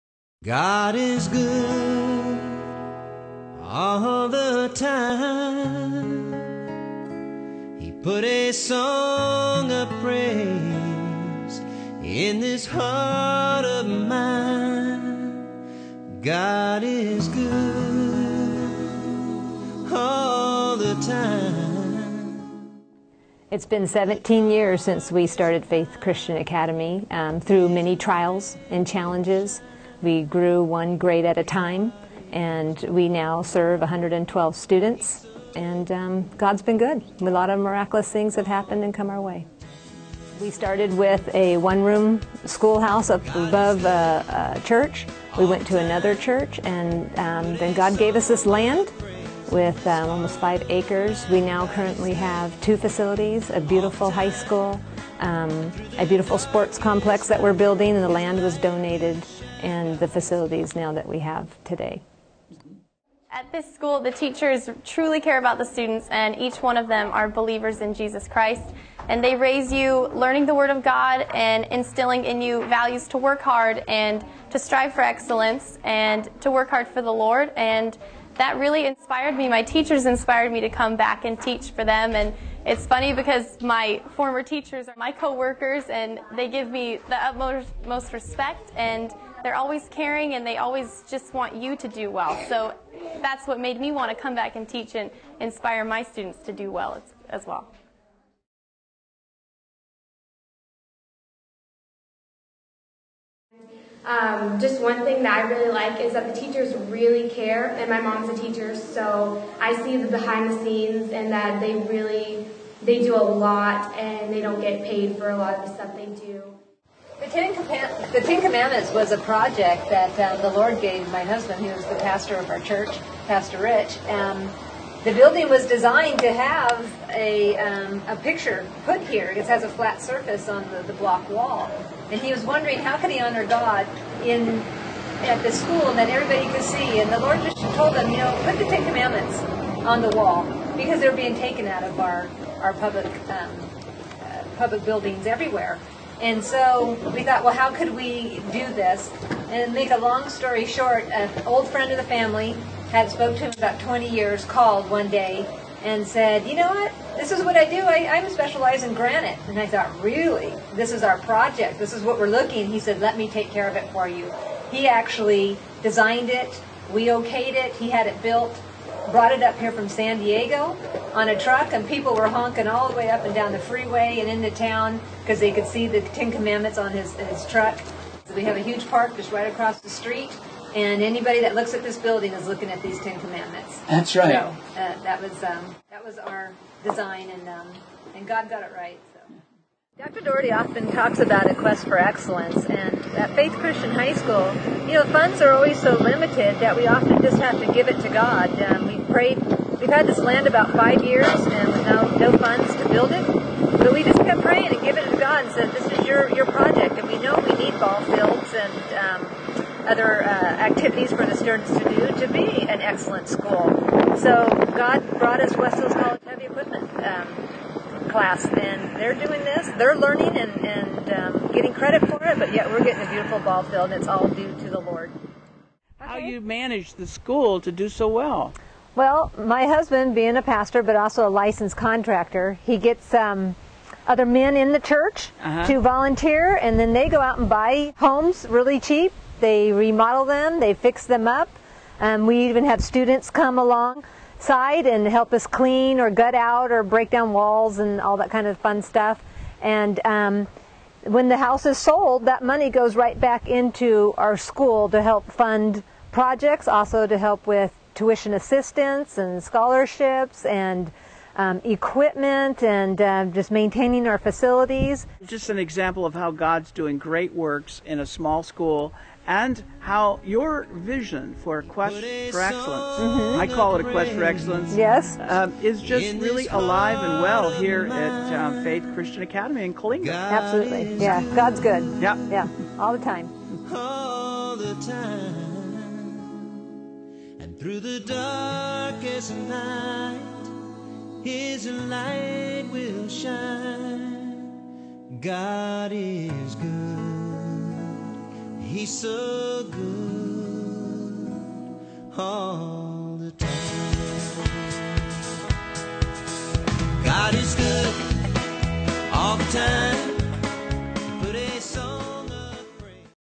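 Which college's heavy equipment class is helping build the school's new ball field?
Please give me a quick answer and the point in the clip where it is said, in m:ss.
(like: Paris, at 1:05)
West Hills College, at 3:35.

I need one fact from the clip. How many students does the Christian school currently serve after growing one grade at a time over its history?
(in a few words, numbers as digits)
112.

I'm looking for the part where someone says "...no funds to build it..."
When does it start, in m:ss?
3:22.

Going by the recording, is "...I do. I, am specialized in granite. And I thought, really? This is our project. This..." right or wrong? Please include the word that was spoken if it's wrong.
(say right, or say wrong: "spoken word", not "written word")
right.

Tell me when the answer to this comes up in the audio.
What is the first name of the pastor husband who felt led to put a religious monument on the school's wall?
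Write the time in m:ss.
2:03.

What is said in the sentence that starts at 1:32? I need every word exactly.
So that's what made me want to come back and teach and inspire my students to do well as, as well.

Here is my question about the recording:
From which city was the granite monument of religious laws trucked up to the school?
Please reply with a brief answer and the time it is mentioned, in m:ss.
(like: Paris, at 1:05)
San Diego, at 2:49.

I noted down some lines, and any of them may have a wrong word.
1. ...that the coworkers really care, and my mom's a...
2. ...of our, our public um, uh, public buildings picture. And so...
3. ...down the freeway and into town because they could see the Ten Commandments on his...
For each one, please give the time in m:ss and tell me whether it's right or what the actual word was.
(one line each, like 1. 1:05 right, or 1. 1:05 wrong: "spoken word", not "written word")
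1. 1:46 wrong: "teachers", not "coworkers"
2. 2:21 wrong: "everywhere", not "picture"
3. 2:53 right.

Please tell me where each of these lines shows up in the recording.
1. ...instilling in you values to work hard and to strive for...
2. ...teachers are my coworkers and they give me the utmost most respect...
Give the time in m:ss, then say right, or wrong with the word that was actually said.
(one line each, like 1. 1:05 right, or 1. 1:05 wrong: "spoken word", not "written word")
1. 1:11 right
2. 1:24 right.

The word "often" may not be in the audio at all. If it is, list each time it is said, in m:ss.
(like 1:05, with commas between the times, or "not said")
3:10, 3:16.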